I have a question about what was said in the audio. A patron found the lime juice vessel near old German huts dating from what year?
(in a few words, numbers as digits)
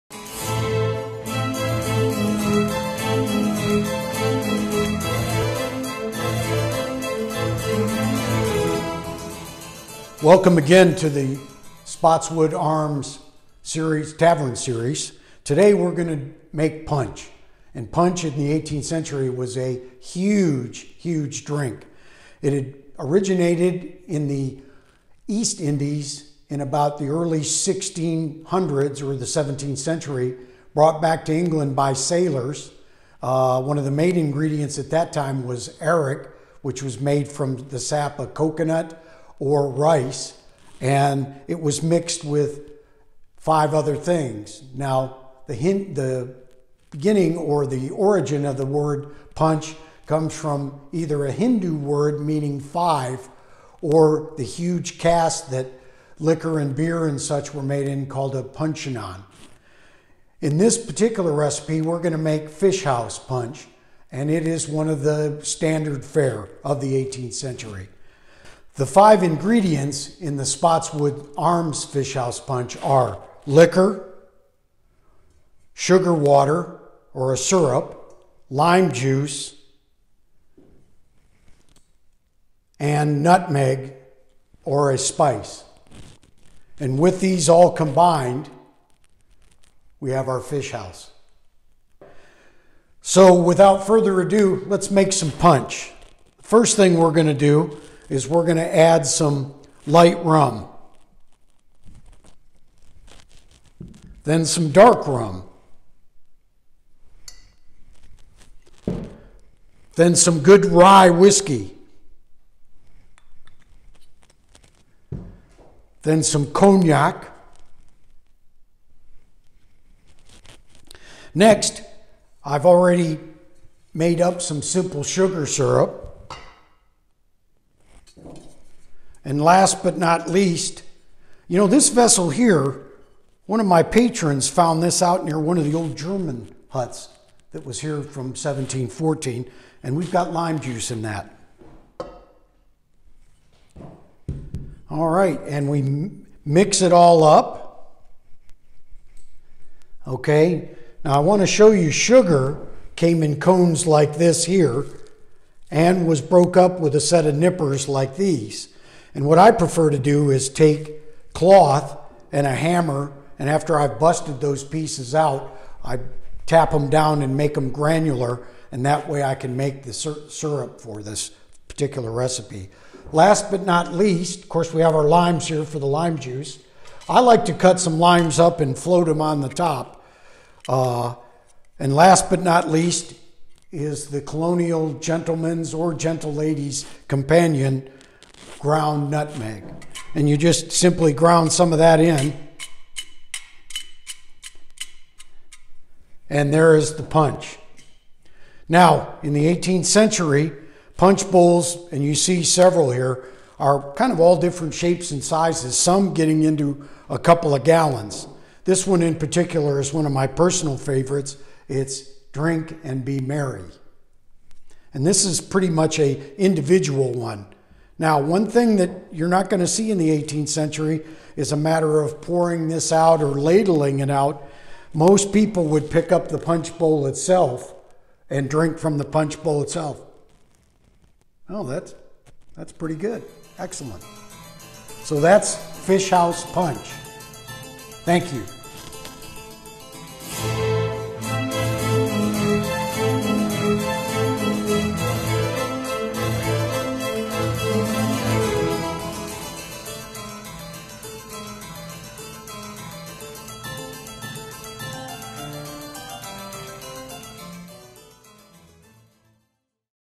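1714.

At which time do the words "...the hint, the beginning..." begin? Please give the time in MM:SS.
00:45.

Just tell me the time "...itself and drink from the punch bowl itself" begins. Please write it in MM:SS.
03:47.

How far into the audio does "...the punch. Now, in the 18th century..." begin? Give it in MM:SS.
03:16.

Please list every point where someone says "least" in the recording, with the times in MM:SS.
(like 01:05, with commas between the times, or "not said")
02:10, 02:53, 03:02.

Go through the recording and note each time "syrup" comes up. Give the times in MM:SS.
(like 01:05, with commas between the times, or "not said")
01:17, 02:05, 02:49.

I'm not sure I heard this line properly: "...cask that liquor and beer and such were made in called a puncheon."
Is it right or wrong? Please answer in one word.
right.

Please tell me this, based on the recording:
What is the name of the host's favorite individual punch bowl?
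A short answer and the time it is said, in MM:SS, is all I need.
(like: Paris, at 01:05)
Drink and Be Merry, at 03:32.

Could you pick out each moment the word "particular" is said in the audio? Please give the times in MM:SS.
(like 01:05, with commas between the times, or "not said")
01:00, 02:51, 03:29.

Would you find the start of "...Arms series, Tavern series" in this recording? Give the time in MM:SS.
00:12.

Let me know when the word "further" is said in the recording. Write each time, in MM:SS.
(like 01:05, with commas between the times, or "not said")
01:33.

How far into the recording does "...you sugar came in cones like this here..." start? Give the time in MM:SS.
02:31.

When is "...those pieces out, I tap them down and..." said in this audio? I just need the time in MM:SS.
02:44.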